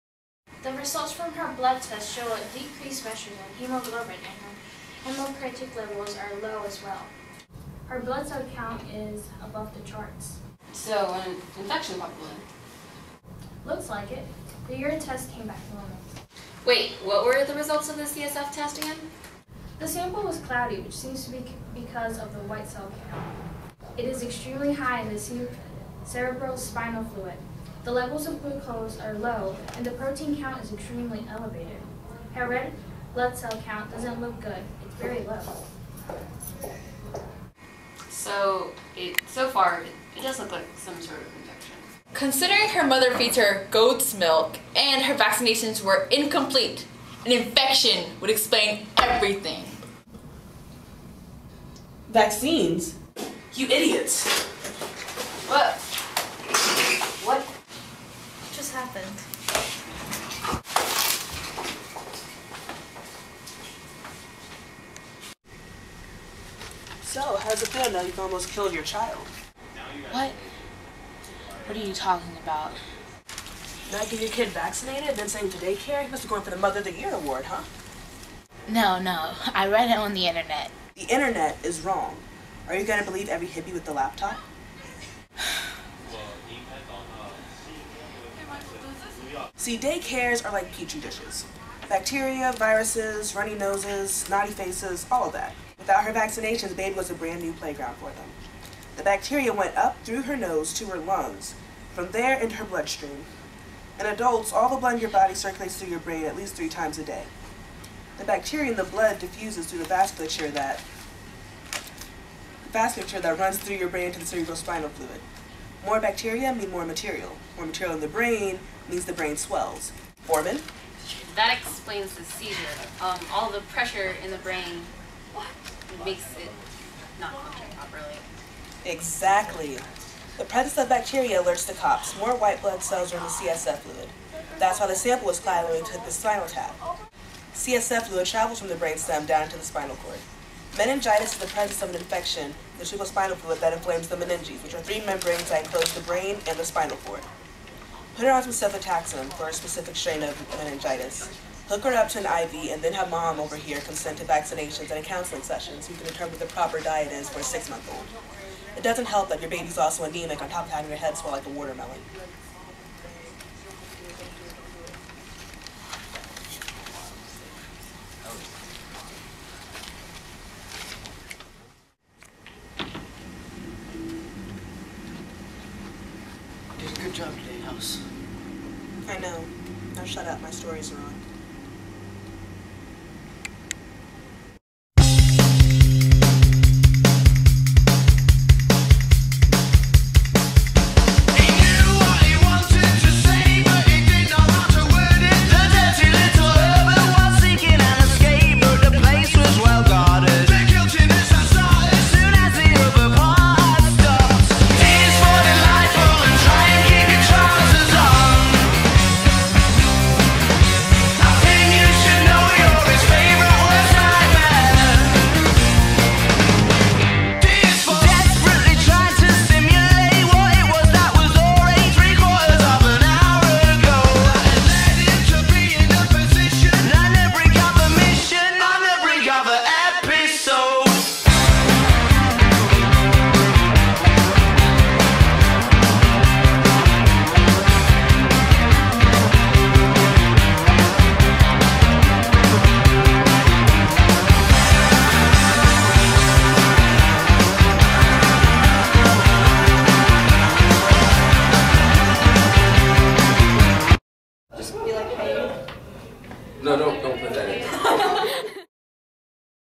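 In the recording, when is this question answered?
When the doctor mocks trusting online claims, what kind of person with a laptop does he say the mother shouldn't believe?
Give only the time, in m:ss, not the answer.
1:23.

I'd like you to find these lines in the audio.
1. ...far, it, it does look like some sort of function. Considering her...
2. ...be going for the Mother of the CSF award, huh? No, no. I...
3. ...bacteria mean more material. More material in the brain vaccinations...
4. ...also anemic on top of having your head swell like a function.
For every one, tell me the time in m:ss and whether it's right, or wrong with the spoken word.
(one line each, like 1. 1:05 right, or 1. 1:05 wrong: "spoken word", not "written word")
1. 0:39 wrong: "infection", not "function"
2. 1:16 wrong: "Year", not "CSF"
3. 1:55 wrong: "means", not "vaccinations"
4. 2:39 wrong: "watermelon", not "function".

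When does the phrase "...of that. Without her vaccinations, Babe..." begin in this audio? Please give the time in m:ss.
1:35.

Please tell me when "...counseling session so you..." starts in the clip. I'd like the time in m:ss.
2:35.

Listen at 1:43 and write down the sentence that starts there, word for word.
In adults, all the blood in your body circulates through your brain at least three times a day.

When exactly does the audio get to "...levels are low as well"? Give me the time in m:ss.
0:05.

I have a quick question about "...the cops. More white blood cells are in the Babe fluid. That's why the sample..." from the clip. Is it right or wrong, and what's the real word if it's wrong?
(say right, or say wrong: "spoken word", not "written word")
wrong: "CSF", not "Babe".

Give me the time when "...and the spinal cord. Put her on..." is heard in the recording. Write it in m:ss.
2:26.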